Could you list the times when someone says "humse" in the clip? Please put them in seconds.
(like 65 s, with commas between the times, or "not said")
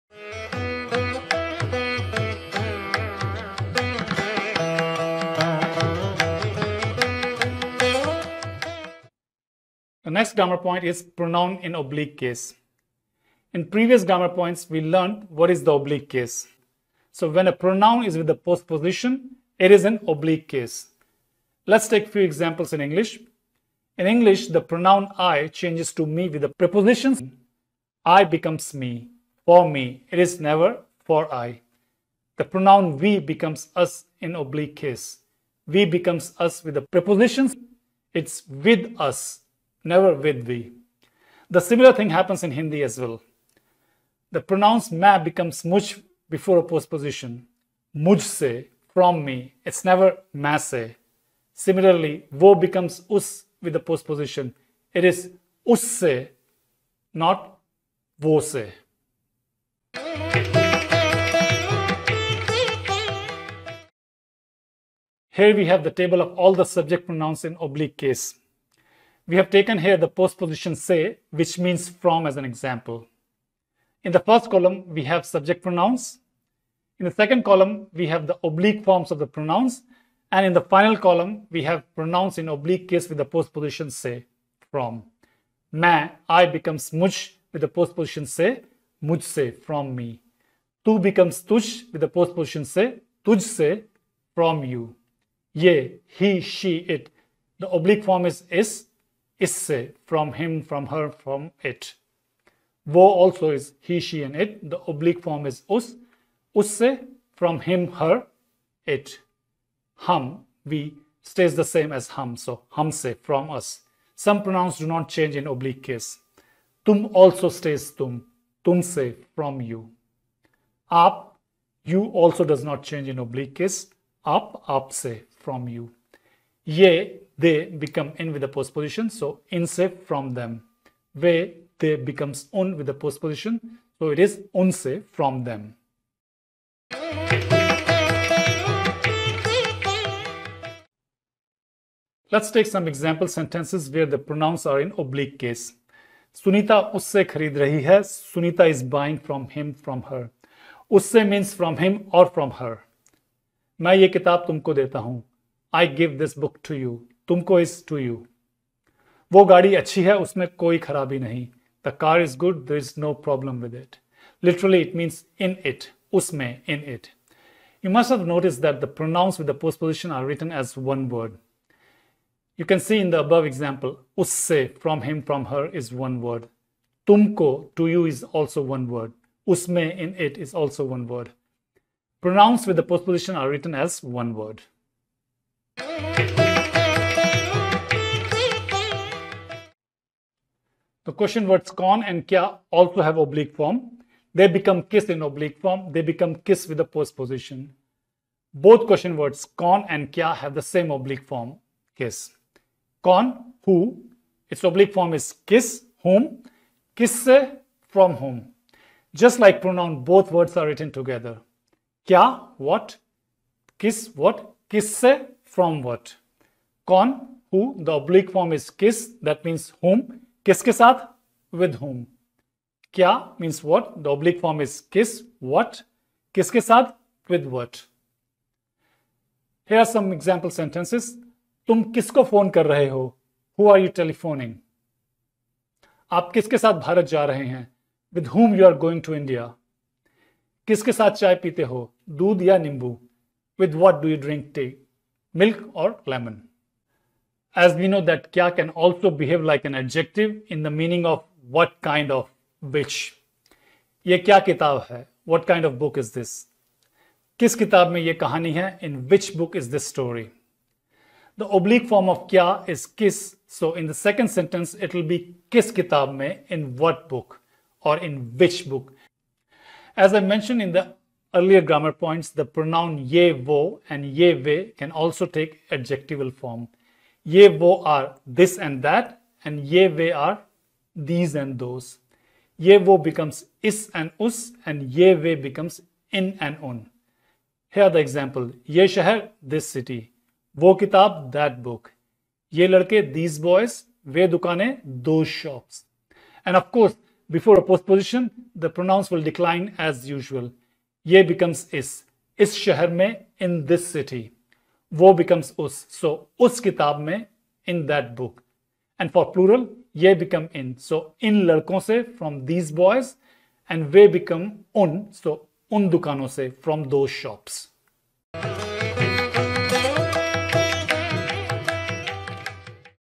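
112 s.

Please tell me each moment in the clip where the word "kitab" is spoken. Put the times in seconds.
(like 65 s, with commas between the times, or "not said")
265 s, 290 s.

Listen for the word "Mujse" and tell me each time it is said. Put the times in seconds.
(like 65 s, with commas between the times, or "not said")
47 s.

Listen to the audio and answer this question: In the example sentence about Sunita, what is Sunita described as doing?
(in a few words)
buying.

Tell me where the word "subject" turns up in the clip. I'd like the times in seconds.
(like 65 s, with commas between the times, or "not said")
66 s, 75 s.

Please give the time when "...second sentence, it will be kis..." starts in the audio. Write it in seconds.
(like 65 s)
263 s.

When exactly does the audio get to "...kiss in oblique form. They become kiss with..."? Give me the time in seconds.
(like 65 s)
194 s.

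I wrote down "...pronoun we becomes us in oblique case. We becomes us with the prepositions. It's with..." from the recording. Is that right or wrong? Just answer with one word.
right.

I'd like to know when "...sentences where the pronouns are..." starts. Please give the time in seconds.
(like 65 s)
143 s.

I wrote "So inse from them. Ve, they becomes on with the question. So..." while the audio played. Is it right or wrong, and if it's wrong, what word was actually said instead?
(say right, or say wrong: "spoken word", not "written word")
wrong: "postposition", not "question".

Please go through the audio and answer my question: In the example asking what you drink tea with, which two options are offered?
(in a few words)
milk or lemon.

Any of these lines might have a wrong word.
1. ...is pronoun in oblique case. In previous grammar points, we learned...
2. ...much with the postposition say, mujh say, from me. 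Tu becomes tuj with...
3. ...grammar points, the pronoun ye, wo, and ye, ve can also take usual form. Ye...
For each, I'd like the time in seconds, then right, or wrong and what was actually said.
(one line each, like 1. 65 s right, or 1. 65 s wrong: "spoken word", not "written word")
1. 10 s right
2. 86 s right
3. 271 s wrong: "adjectival", not "usual".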